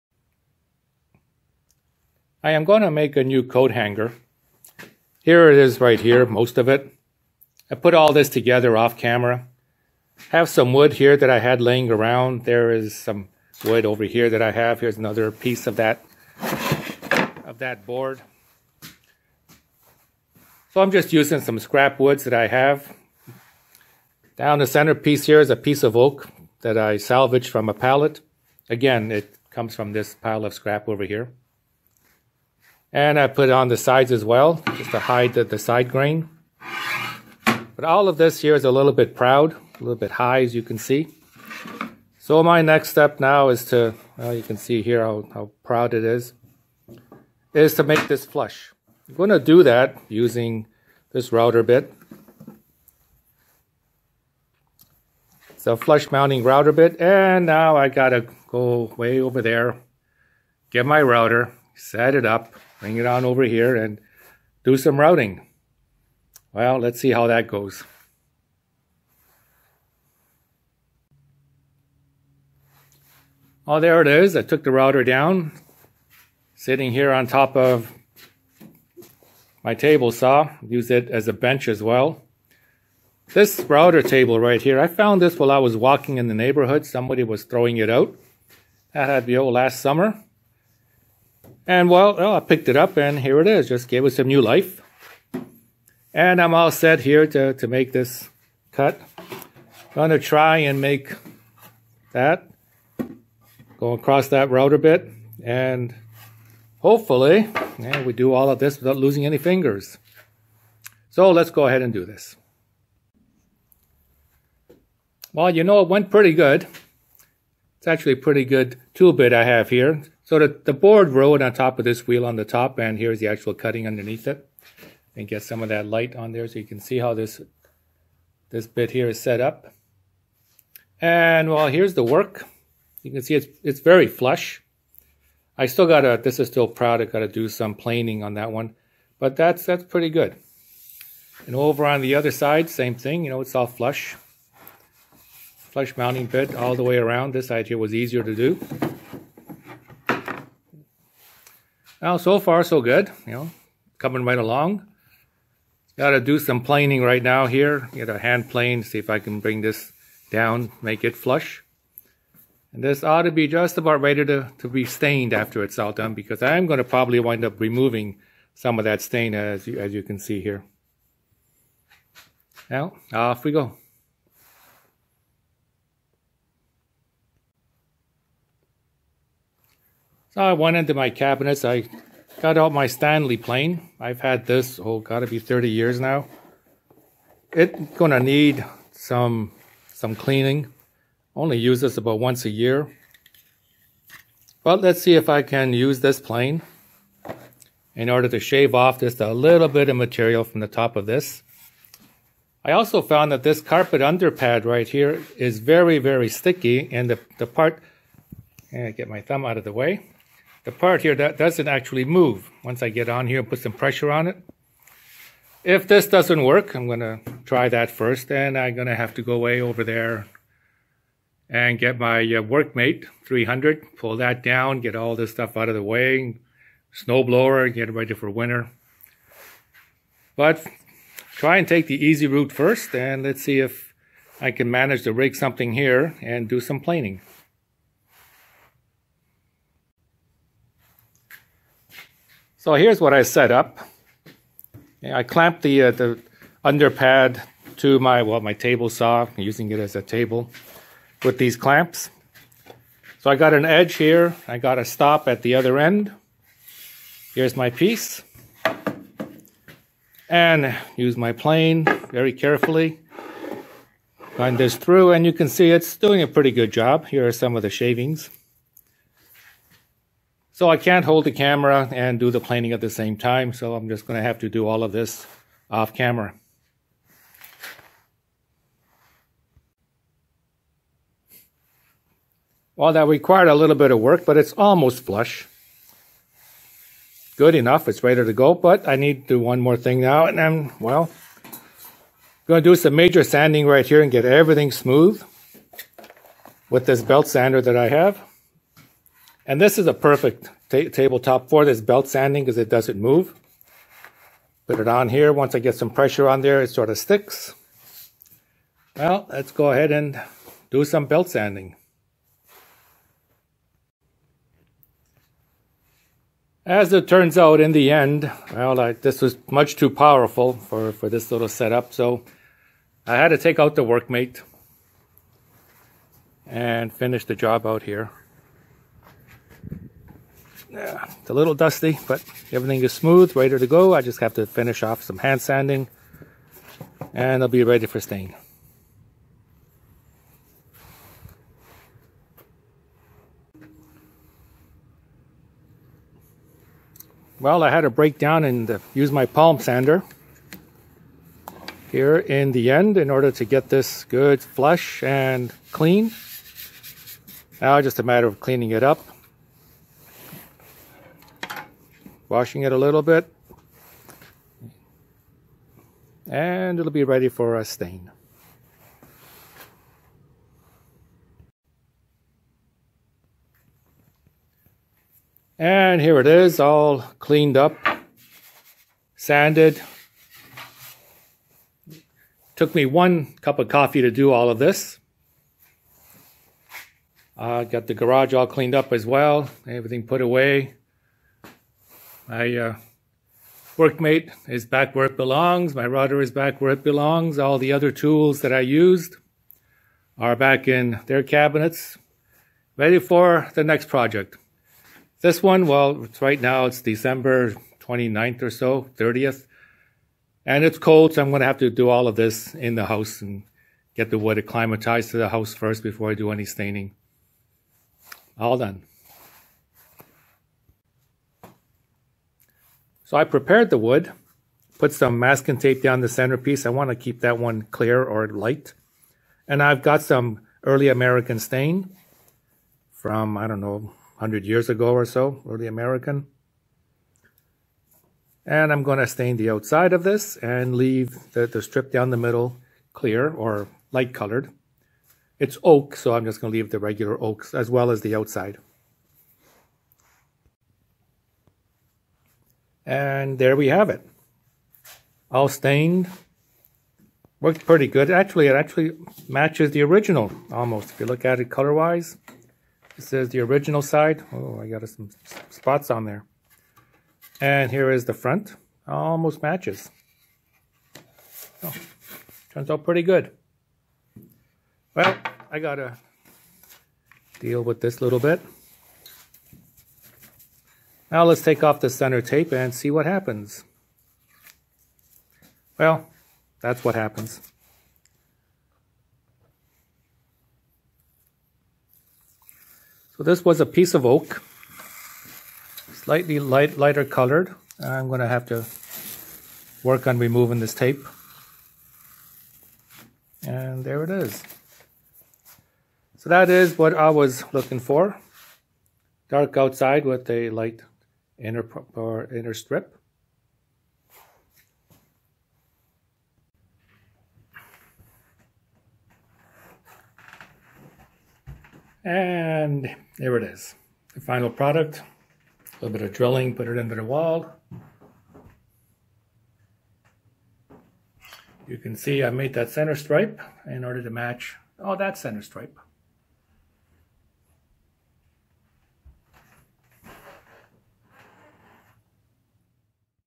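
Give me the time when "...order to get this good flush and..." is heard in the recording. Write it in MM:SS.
05:53.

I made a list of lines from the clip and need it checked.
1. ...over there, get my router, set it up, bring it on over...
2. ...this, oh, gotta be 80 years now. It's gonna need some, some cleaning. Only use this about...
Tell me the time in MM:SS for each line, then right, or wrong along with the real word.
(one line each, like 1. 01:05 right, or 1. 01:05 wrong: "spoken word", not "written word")
1. 00:59 right
2. 03:04 wrong: "30", not "80".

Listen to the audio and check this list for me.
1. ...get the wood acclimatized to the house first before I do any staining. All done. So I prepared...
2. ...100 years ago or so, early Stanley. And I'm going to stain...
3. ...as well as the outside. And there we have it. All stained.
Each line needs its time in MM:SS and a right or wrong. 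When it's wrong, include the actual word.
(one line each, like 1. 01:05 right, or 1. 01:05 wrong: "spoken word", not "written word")
1. 06:53 right
2. 07:14 wrong: "American", not "Stanley"
3. 07:27 right.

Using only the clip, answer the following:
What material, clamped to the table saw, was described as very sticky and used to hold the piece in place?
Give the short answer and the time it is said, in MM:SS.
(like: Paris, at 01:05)
Carpet underpad, at 03:23.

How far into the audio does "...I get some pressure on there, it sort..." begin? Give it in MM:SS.
05:05.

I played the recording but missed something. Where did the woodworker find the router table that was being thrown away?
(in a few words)
In the neighborhood.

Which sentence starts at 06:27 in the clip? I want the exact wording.
Uh, got the garage all cleaned up as well, everything put away.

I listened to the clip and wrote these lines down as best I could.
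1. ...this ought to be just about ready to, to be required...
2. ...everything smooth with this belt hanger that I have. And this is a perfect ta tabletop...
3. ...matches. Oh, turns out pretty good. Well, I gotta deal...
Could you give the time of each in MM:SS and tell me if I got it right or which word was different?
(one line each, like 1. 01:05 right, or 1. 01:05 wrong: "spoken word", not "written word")
1. 02:42 wrong: "stained", not "required"
2. 04:54 wrong: "sander", not "hanger"
3. 07:49 right.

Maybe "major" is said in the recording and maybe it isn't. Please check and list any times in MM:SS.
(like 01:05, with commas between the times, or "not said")
04:52.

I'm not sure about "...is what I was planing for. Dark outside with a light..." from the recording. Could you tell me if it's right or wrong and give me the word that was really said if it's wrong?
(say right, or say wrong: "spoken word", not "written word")
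wrong: "looking", not "planing".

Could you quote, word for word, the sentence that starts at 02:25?
Flush mounting bit all the way around.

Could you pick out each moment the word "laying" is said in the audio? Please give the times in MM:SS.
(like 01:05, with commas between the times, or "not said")
00:11.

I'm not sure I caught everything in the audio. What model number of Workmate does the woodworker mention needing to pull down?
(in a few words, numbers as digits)
300.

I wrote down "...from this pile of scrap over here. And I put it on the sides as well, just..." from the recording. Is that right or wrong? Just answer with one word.
right.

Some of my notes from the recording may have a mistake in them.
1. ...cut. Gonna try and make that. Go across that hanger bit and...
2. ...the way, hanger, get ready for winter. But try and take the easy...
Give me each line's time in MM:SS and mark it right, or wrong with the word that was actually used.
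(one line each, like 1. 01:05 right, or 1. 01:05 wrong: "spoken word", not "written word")
1. 01:38 wrong: "router", not "hanger"
2. 03:45 wrong: "snowblower", not "hanger".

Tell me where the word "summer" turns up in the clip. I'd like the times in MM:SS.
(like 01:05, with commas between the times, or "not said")
01:29.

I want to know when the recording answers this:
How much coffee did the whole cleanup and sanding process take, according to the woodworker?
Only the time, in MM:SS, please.
06:22.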